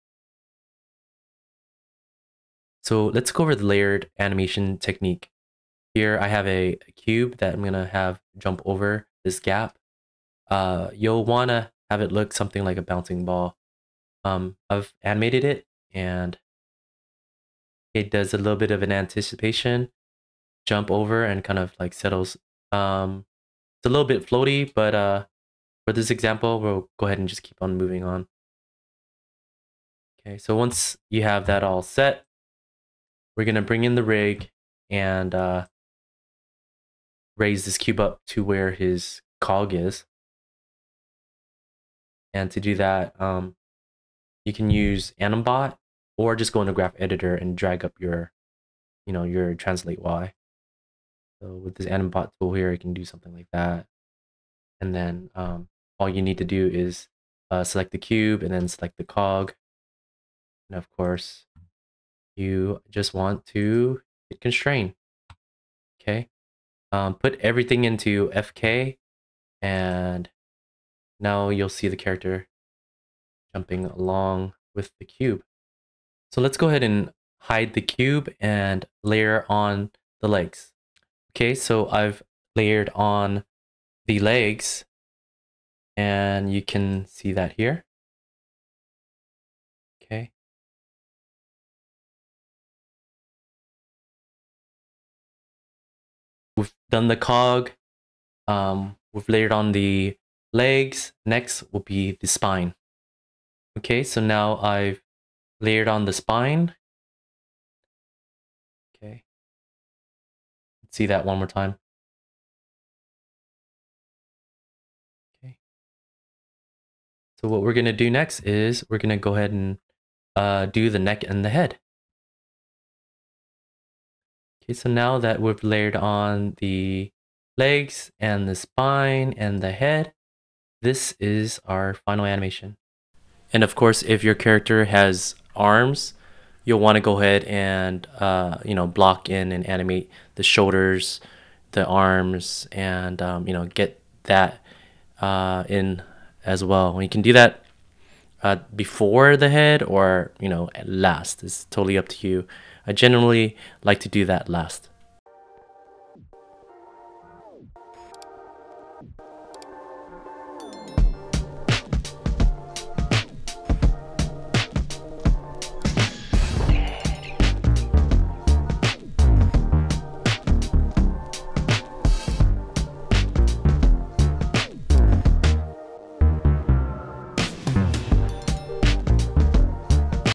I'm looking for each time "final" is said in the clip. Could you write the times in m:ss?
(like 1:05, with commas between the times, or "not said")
2:12.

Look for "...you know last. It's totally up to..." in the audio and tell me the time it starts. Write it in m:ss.
2:30.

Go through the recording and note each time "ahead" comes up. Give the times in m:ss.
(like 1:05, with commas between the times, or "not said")
0:27, 1:16, 1:59, 2:17.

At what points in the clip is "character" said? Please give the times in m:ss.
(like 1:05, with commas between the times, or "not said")
1:11, 2:14.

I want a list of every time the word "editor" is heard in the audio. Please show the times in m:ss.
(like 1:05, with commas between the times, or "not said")
0:46.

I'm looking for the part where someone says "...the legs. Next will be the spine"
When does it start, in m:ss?
1:39.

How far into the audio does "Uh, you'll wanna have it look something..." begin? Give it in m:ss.
0:10.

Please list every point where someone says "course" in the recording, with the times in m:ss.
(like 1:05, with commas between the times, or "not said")
1:00, 2:13.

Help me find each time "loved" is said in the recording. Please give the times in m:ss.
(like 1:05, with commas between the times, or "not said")
not said.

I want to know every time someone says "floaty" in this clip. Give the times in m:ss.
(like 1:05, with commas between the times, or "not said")
0:24.